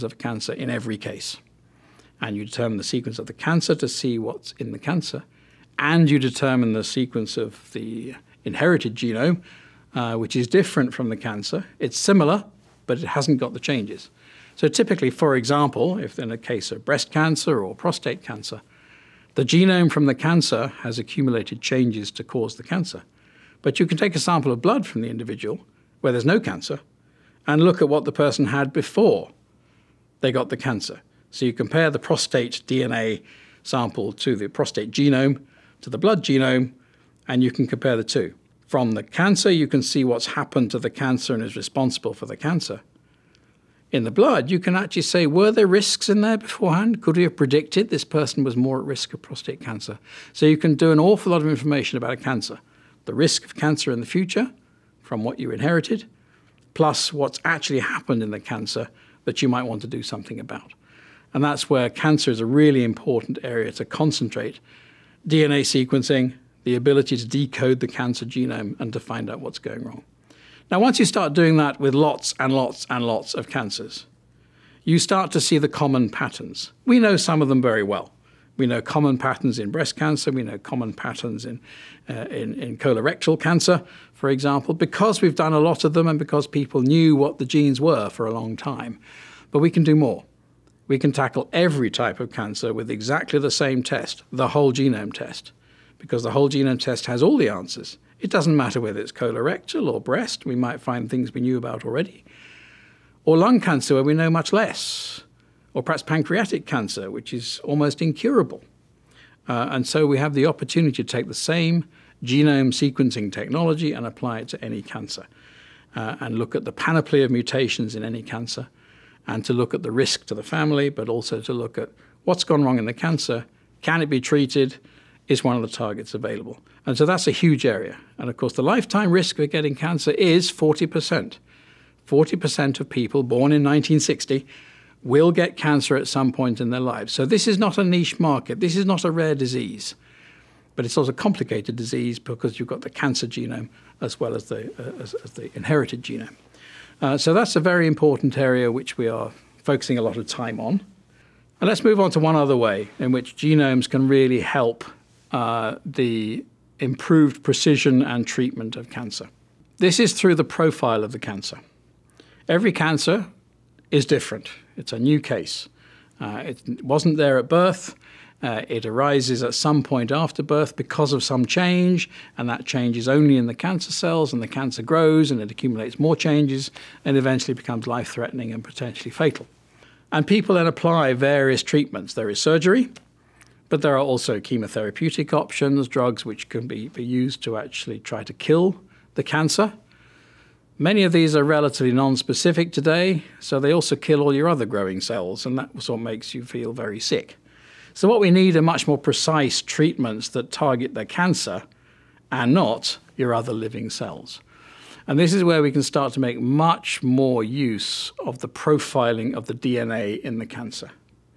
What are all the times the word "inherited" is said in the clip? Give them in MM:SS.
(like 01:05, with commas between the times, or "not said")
00:08, 00:55, 02:25.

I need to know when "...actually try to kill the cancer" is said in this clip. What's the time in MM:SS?
03:07.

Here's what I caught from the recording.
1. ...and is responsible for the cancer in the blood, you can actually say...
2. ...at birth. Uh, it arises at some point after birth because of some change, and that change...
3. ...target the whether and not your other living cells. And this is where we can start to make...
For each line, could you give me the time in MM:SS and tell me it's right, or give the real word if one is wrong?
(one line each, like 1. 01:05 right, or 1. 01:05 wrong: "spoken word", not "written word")
1. 00:41 right
2. 02:47 right
3. 03:20 wrong: "cancer", not "whether".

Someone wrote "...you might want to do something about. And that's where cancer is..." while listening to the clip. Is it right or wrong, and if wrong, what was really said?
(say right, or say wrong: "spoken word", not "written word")
right.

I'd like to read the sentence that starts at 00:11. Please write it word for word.
It's similar, but it hasn't got the changes.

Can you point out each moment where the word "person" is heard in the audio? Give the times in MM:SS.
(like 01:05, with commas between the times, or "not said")
00:28, 00:48.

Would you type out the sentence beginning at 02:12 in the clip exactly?
40% of people born in 1960 will get cancer at some point in their lives.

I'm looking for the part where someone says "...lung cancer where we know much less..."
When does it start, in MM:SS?
01:43.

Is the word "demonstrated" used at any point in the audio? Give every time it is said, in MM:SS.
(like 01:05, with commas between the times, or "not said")
not said.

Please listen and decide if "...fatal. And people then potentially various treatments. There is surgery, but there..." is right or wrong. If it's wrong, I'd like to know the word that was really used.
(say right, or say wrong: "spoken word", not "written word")
wrong: "apply", not "potentially".